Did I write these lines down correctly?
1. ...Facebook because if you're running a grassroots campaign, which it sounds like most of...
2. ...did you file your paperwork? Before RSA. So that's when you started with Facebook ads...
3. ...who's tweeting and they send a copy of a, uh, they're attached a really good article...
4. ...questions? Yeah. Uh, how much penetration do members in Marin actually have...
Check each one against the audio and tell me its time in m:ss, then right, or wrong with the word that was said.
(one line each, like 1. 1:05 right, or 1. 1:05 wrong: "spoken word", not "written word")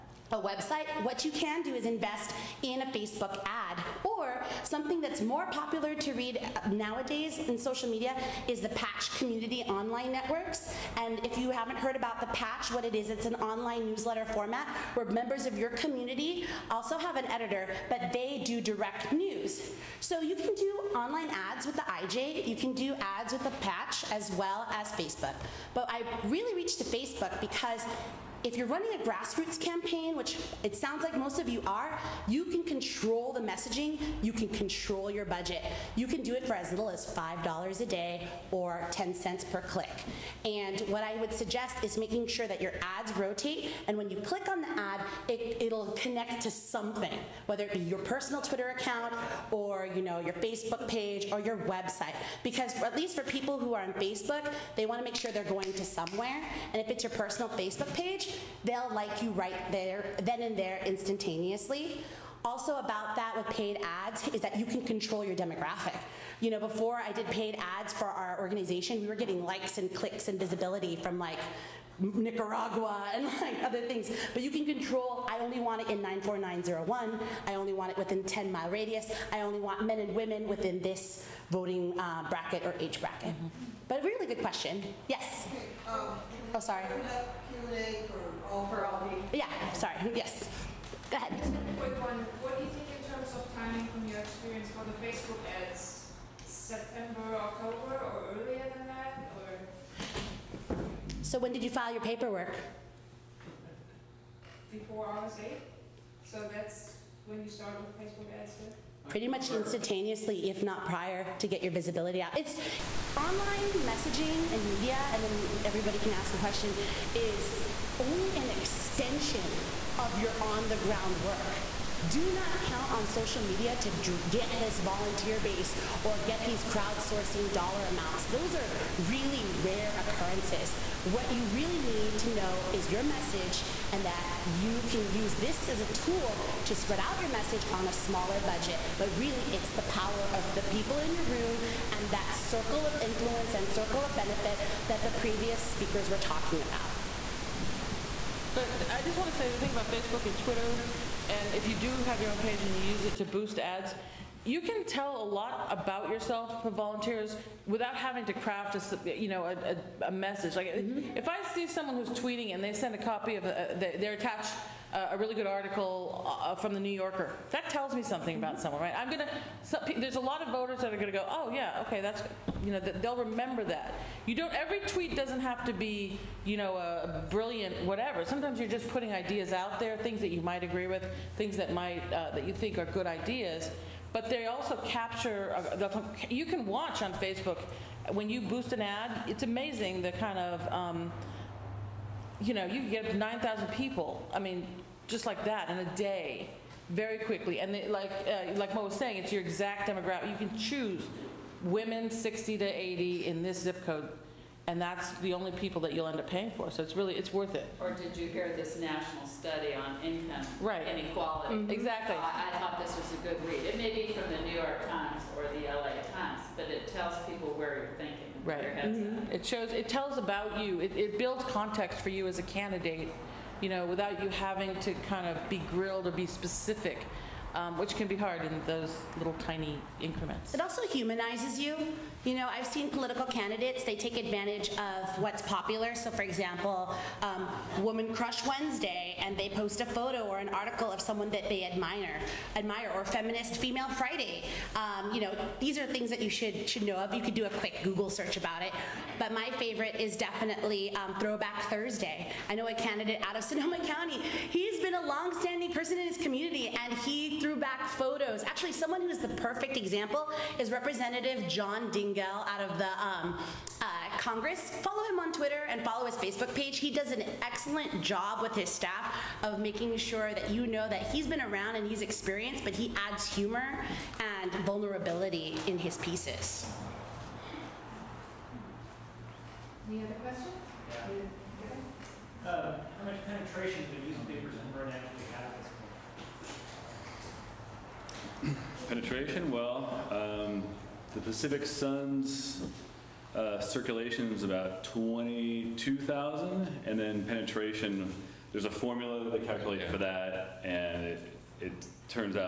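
1. 0:26 right
2. 1:41 right
3. 2:41 right
4. 4:40 wrong: "newspapers", not "members".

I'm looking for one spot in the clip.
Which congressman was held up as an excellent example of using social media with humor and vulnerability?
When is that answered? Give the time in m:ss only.
4:21.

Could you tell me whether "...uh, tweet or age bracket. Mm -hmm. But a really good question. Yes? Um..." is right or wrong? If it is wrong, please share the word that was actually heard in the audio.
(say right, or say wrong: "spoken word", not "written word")
wrong: "bracket", not "tweet".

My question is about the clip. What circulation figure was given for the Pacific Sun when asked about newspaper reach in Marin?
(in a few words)
22,000.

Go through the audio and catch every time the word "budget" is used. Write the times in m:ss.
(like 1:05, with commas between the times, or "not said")
0:35, 2:18.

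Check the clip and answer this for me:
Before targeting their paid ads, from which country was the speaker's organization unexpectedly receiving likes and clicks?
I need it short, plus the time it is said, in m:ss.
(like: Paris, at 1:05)
Nicaragua, at 1:11.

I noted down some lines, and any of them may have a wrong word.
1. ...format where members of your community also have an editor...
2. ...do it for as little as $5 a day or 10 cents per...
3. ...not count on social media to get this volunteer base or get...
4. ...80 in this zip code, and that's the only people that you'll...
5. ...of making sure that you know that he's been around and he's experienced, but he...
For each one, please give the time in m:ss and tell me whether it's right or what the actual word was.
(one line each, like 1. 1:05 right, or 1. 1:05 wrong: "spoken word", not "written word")
1. 0:14 right
2. 0:36 right
3. 2:02 right
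4. 3:22 right
5. 4:29 right.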